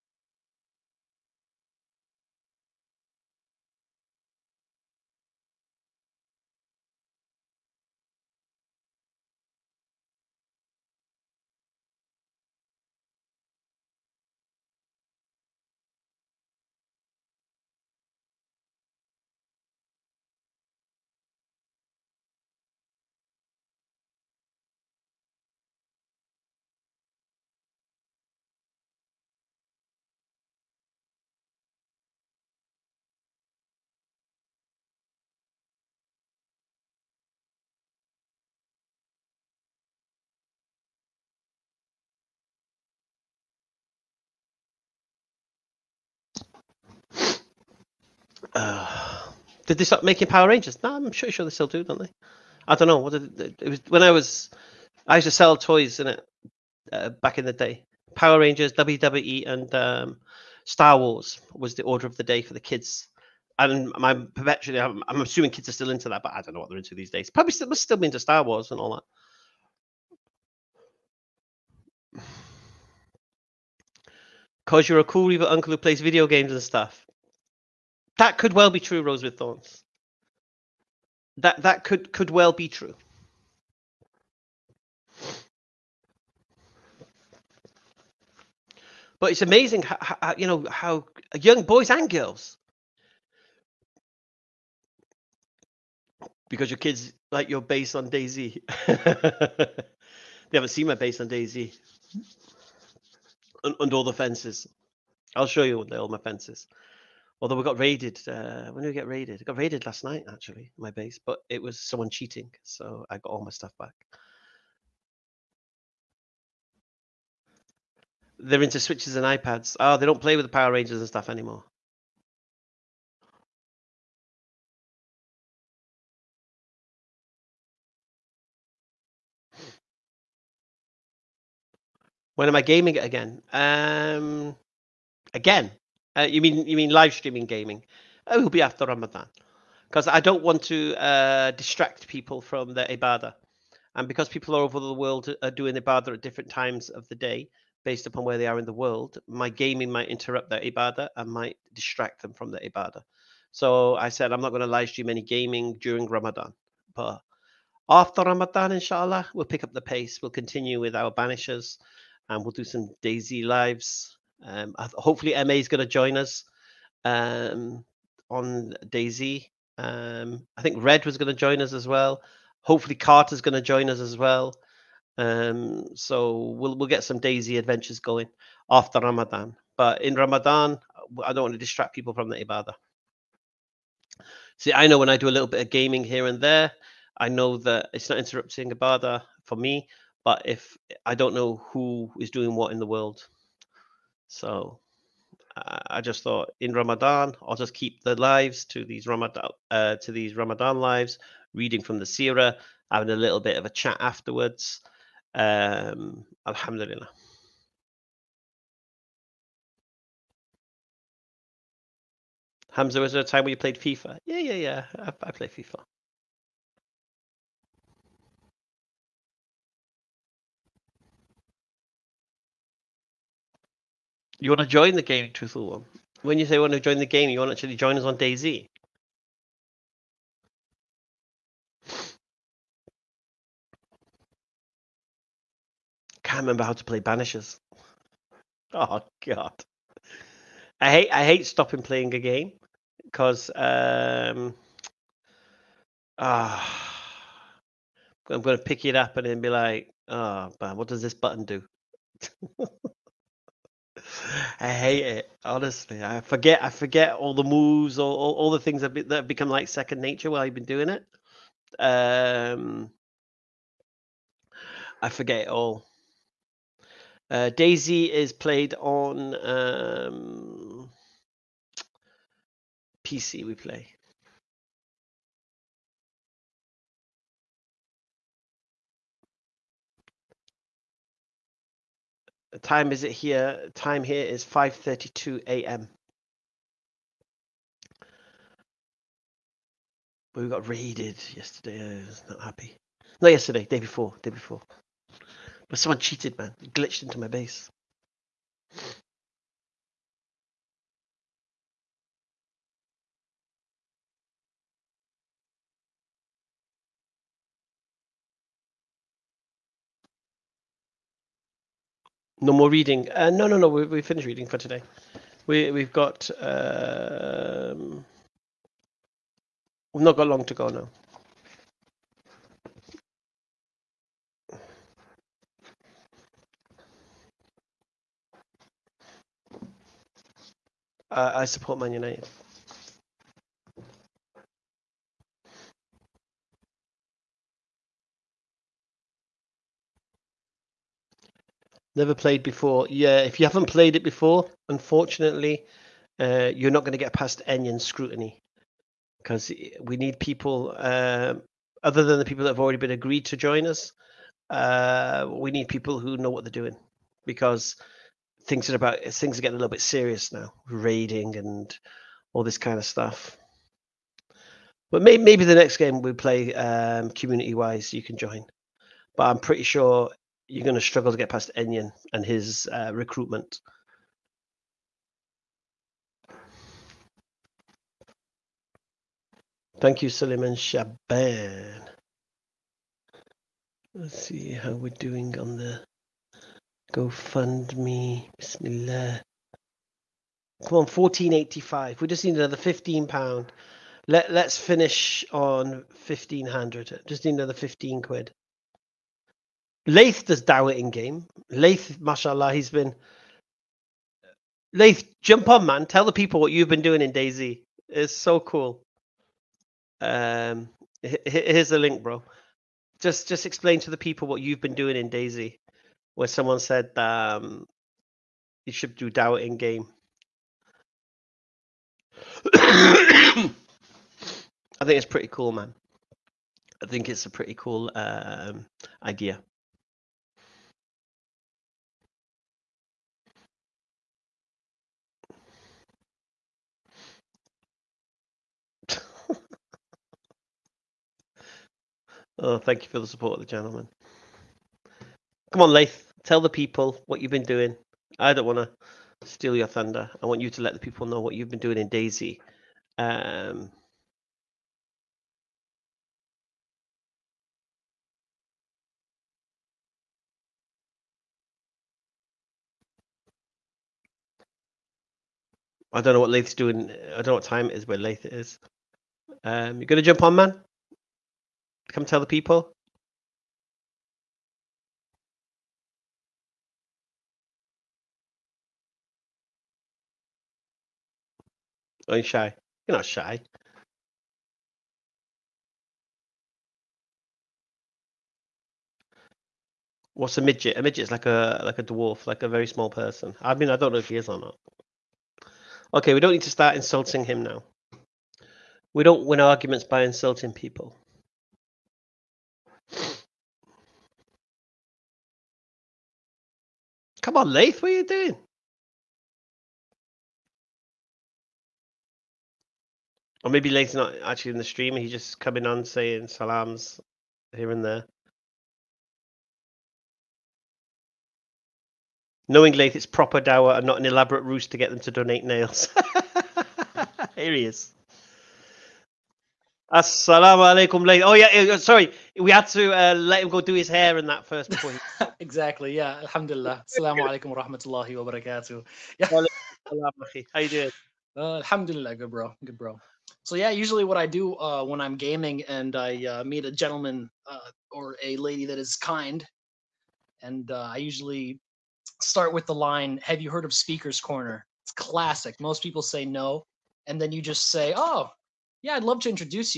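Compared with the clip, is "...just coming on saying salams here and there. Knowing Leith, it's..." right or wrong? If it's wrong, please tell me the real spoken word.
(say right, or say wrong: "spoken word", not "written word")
right.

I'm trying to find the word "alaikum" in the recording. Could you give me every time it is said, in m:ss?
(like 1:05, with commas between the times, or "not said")
8:50, 8:57.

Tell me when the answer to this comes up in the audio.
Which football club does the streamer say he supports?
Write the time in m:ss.
5:31.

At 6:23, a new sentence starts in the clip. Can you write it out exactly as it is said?
Let's see how we're doing on the GoFundMe.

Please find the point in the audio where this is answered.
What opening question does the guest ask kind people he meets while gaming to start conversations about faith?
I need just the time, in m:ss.
9:13.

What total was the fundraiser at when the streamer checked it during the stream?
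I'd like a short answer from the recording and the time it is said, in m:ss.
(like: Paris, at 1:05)
1485, at 6:30.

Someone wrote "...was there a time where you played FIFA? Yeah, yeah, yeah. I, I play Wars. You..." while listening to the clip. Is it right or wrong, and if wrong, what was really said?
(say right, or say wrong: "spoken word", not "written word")
wrong: "FIFA", not "Wars".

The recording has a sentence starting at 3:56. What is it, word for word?
Can't remember how to play Banishers.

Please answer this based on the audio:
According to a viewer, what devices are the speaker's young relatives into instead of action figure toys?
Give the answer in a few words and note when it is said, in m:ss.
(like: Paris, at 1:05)
Switches and iPads, at 1:58.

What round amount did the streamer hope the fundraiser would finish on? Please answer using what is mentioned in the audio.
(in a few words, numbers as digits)
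1500.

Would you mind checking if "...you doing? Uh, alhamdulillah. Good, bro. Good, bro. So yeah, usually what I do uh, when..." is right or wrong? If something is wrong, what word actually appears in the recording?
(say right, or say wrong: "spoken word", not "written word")
right.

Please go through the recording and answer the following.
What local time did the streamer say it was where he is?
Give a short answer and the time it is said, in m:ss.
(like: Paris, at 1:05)
5:32 a.m., at 4:44.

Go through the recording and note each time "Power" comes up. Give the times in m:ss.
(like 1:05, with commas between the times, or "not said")
0:50, 0:58, 2:00.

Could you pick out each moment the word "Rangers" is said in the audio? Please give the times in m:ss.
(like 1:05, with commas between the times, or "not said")
0:50, 0:58, 2:00.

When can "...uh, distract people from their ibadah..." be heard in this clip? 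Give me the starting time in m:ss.
2:20.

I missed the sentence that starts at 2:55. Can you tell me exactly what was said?
Um, so we'll we'll get some DayZ adventures going after Ramadan.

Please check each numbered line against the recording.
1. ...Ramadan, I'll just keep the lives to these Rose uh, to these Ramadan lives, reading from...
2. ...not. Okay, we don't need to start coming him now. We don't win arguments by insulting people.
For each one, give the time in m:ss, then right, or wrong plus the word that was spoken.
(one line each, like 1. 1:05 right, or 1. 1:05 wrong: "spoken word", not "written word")
1. 3:16 wrong: "Ramadan", not "Rose"
2. 8:14 wrong: "insulting", not "coming".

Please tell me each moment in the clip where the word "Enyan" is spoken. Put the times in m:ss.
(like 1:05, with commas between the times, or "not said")
5:47, 6:11.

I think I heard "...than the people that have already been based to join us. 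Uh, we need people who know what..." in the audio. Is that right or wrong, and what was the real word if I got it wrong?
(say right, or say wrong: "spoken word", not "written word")
wrong: "agreed", not "based".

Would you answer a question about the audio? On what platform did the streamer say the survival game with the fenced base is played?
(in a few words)
PC.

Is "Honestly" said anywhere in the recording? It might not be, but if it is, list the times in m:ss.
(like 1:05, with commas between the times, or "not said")
4:15.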